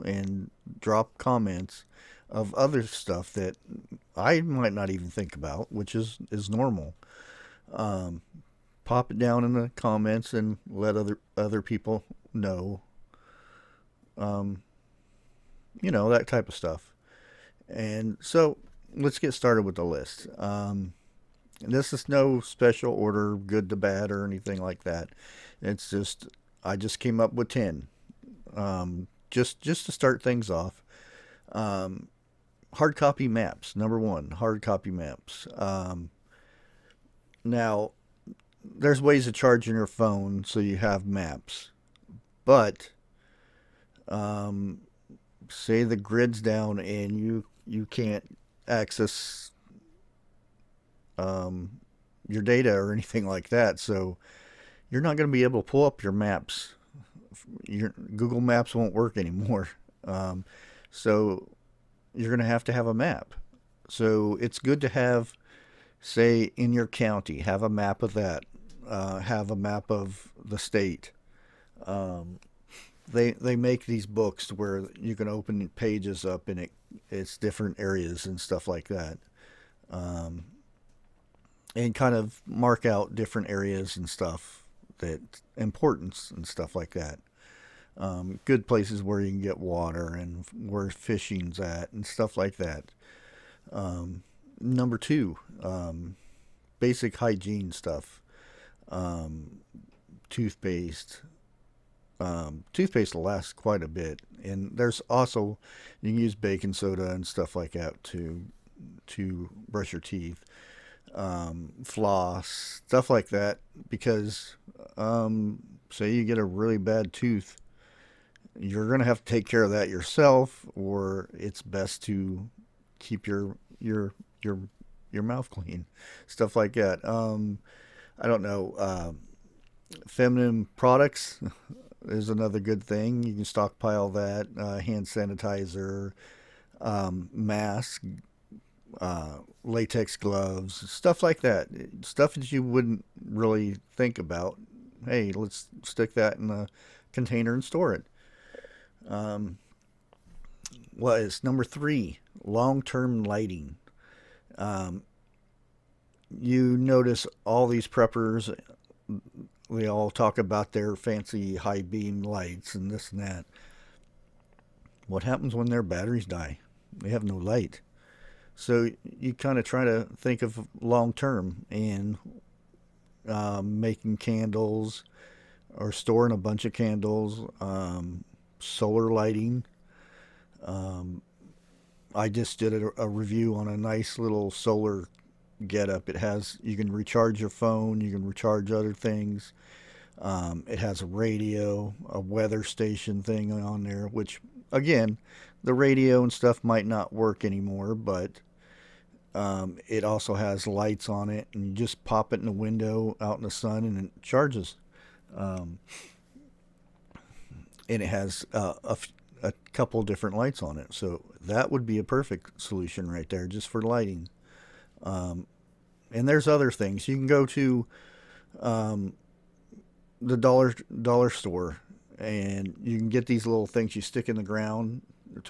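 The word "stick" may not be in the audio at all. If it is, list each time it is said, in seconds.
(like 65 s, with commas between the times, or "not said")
145 s, 224 s.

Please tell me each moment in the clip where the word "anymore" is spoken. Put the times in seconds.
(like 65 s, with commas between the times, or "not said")
59 s, 197 s.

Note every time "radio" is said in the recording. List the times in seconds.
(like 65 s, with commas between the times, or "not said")
191 s, 195 s.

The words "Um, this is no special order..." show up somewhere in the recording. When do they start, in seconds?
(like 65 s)
20 s.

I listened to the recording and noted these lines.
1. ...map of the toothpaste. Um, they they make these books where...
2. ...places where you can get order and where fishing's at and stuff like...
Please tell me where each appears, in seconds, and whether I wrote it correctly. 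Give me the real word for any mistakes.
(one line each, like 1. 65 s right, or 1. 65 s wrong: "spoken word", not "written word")
1. 69 s wrong: "state", not "toothpaste"
2. 88 s wrong: "water", not "order".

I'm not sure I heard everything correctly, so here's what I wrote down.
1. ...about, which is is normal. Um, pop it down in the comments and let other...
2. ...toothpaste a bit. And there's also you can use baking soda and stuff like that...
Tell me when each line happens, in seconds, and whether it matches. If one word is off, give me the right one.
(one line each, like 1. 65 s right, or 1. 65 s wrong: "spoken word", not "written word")
1. 5 s right
2. 103 s wrong: "quite", not "toothpaste".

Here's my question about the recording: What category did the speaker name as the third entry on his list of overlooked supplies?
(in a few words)
Long-term lighting.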